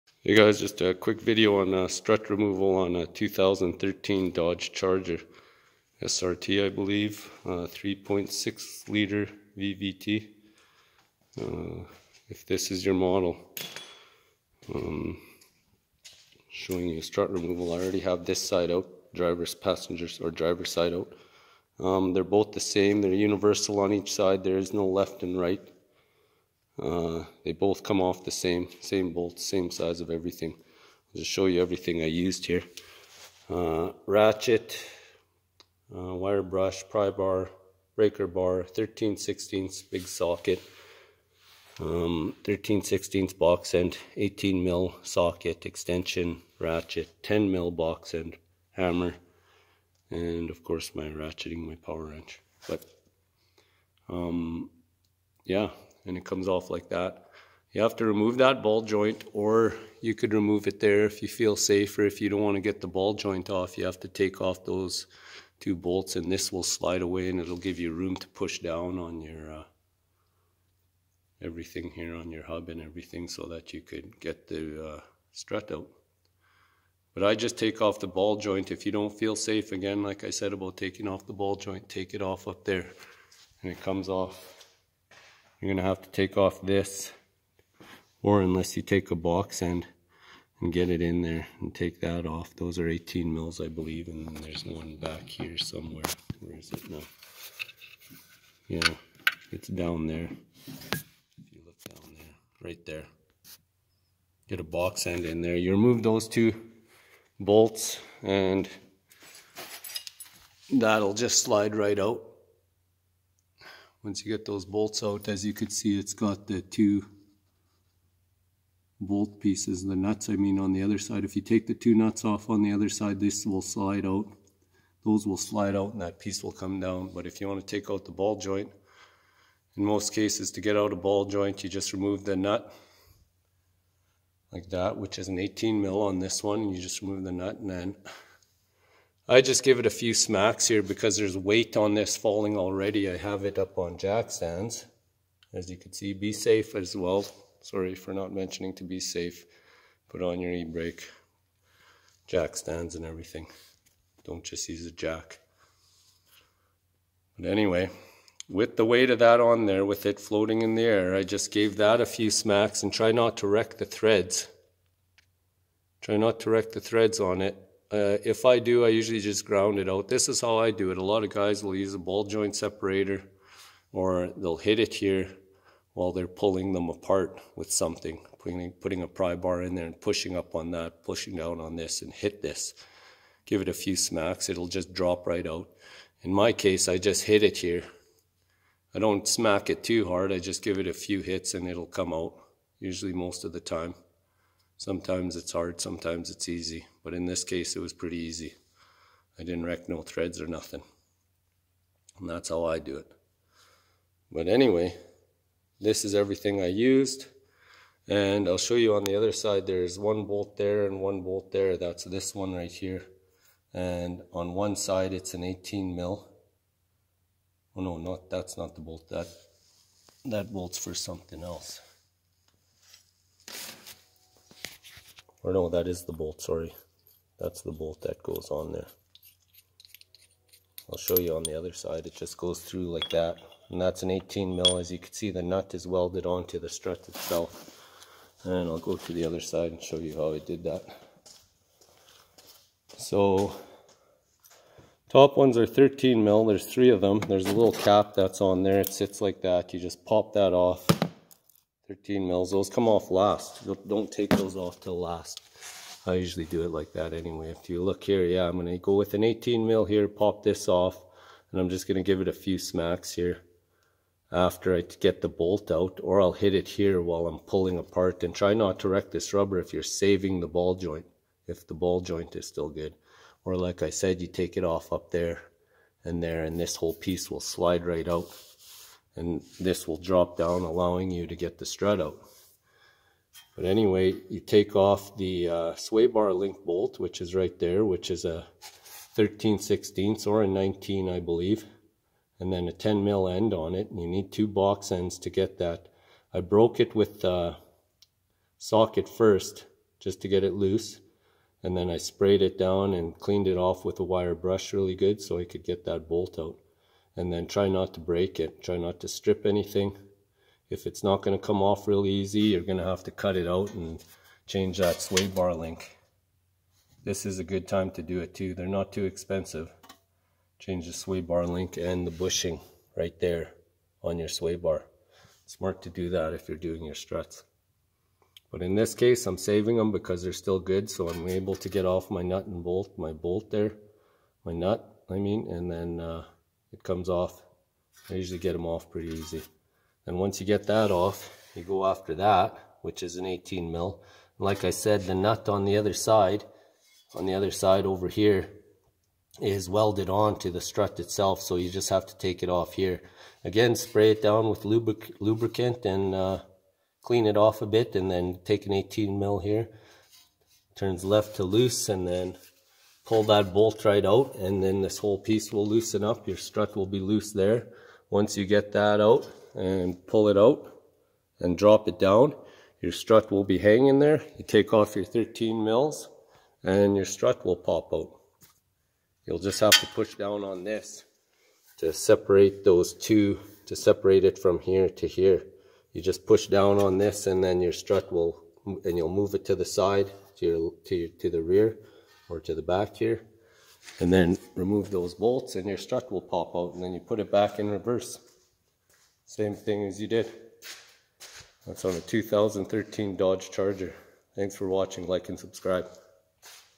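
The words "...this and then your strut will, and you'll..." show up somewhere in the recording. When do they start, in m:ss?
6:26.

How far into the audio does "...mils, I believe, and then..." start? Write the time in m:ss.
1:33.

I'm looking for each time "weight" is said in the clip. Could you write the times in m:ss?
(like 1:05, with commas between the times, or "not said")
2:21, 2:38.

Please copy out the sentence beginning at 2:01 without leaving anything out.
If you take the two nuts off on the other side, this will slide out.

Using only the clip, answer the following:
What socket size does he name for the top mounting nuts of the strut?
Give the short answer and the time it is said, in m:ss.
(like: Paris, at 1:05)
13 mil, at 4:02.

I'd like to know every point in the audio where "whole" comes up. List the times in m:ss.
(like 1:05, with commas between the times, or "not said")
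4:36, 6:04.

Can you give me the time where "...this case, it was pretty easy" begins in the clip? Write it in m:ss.
3:17.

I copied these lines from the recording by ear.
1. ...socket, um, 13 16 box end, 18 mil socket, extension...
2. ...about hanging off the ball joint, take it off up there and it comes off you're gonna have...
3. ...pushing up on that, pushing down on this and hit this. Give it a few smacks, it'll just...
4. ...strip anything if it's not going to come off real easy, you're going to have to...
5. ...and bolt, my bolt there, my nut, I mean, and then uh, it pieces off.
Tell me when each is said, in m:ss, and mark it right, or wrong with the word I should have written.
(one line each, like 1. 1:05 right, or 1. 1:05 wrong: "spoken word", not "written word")
1. 0:40 right
2. 1:20 wrong: "taking", not "hanging"
3. 2:59 right
4. 5:09 right
5. 5:32 wrong: "comes", not "pieces".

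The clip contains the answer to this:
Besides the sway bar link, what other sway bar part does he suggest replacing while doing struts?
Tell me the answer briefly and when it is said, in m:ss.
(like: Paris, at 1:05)
the bushing, at 5:22.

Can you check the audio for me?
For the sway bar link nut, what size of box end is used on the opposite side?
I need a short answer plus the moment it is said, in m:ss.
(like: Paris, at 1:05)
10 mil, at 4:52.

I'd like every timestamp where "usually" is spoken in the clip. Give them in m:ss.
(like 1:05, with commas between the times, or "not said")
2:48, 3:12, 4:16, 5:38.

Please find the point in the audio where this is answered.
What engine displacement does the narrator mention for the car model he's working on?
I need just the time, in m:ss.
0:07.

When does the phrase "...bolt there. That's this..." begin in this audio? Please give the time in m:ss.
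3:31.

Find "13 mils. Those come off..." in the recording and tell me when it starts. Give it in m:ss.
4:11.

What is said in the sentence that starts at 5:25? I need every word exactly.
Smart to do that if you're doing your struts.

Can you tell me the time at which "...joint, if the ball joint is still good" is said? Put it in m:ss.
4:30.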